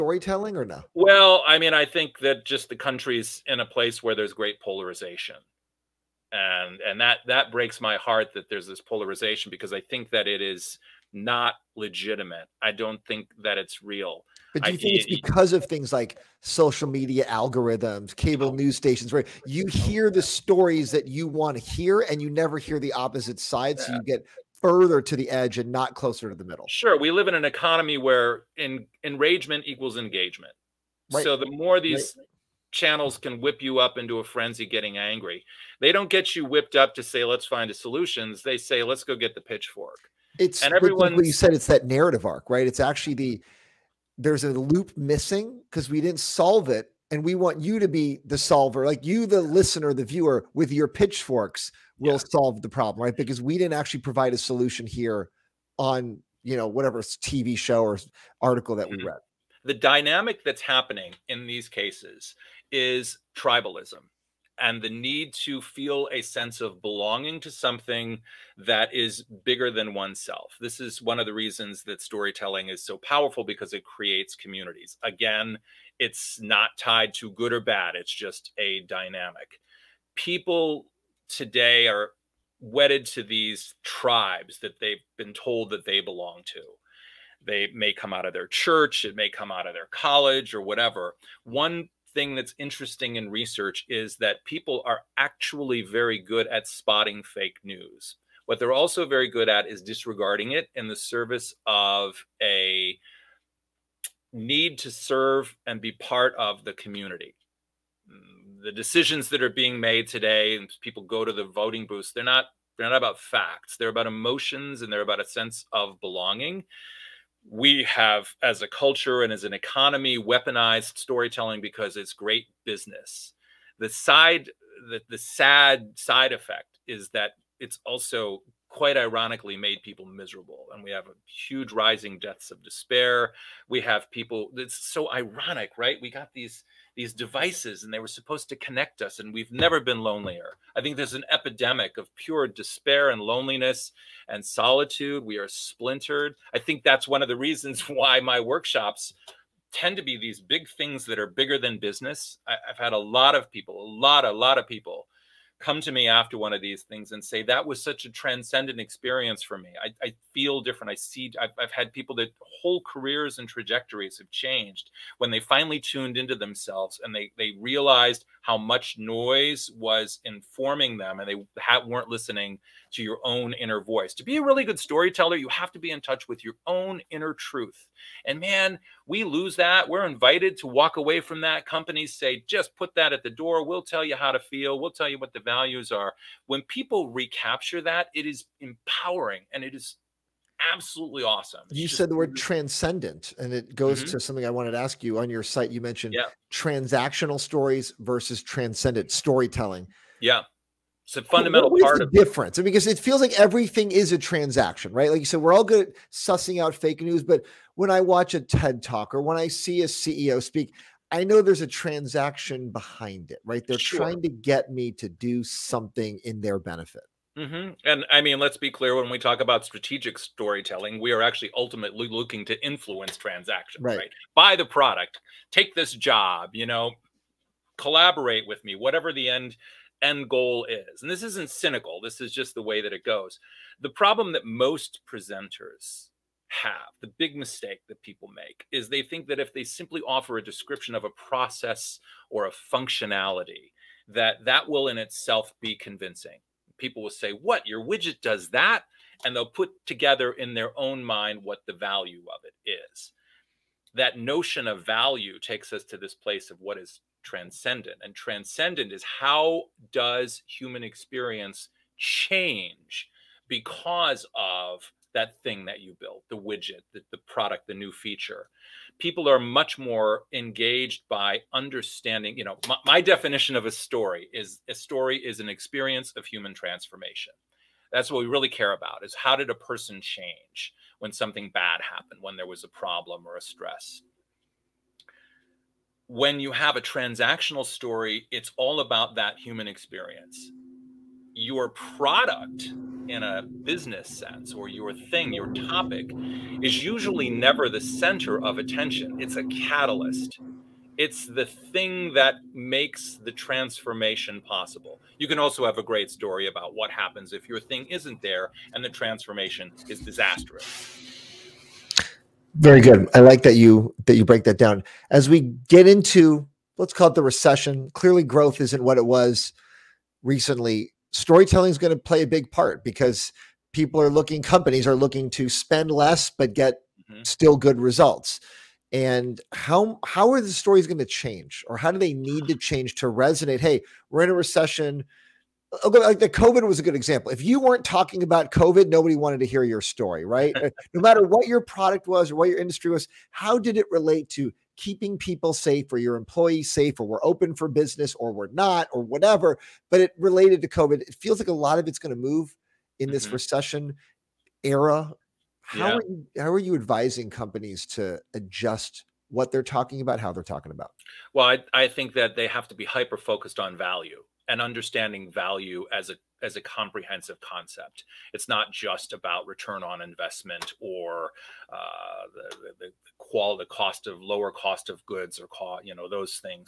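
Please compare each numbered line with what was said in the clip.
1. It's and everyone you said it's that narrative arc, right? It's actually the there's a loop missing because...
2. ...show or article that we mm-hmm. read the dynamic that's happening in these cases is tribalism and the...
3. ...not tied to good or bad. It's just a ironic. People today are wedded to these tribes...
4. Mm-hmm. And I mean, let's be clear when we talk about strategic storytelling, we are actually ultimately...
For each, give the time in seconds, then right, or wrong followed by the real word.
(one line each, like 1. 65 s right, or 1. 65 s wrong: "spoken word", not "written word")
1. 40 s right
2. 57 s right
3. 76 s wrong: "dynamic", not "ironic"
4. 217 s right.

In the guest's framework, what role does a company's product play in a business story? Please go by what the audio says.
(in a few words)
a catalyst.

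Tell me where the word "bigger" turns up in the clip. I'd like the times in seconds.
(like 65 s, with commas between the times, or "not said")
69 s, 151 s.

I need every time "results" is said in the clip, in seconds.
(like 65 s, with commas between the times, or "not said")
327 s.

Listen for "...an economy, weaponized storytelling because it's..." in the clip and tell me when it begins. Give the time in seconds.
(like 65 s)
119 s.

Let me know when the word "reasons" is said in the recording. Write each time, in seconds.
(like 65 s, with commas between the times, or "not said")
71 s, 147 s.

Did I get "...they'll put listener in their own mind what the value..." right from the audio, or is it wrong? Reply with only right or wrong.
wrong.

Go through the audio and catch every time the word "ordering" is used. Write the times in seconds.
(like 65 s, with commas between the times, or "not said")
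not said.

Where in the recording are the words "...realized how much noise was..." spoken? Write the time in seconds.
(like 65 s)
167 s.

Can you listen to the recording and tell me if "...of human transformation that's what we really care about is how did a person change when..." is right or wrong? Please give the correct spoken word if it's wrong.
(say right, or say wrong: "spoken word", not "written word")
right.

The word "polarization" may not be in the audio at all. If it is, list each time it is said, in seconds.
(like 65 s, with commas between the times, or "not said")
4 s, 8 s.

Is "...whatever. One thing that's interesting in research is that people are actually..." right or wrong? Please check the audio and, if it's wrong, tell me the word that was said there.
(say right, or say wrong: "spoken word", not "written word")
right.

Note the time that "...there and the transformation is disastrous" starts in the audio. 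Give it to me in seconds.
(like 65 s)
308 s.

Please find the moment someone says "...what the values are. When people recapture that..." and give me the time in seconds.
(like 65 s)
185 s.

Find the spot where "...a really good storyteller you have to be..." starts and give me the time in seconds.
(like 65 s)
174 s.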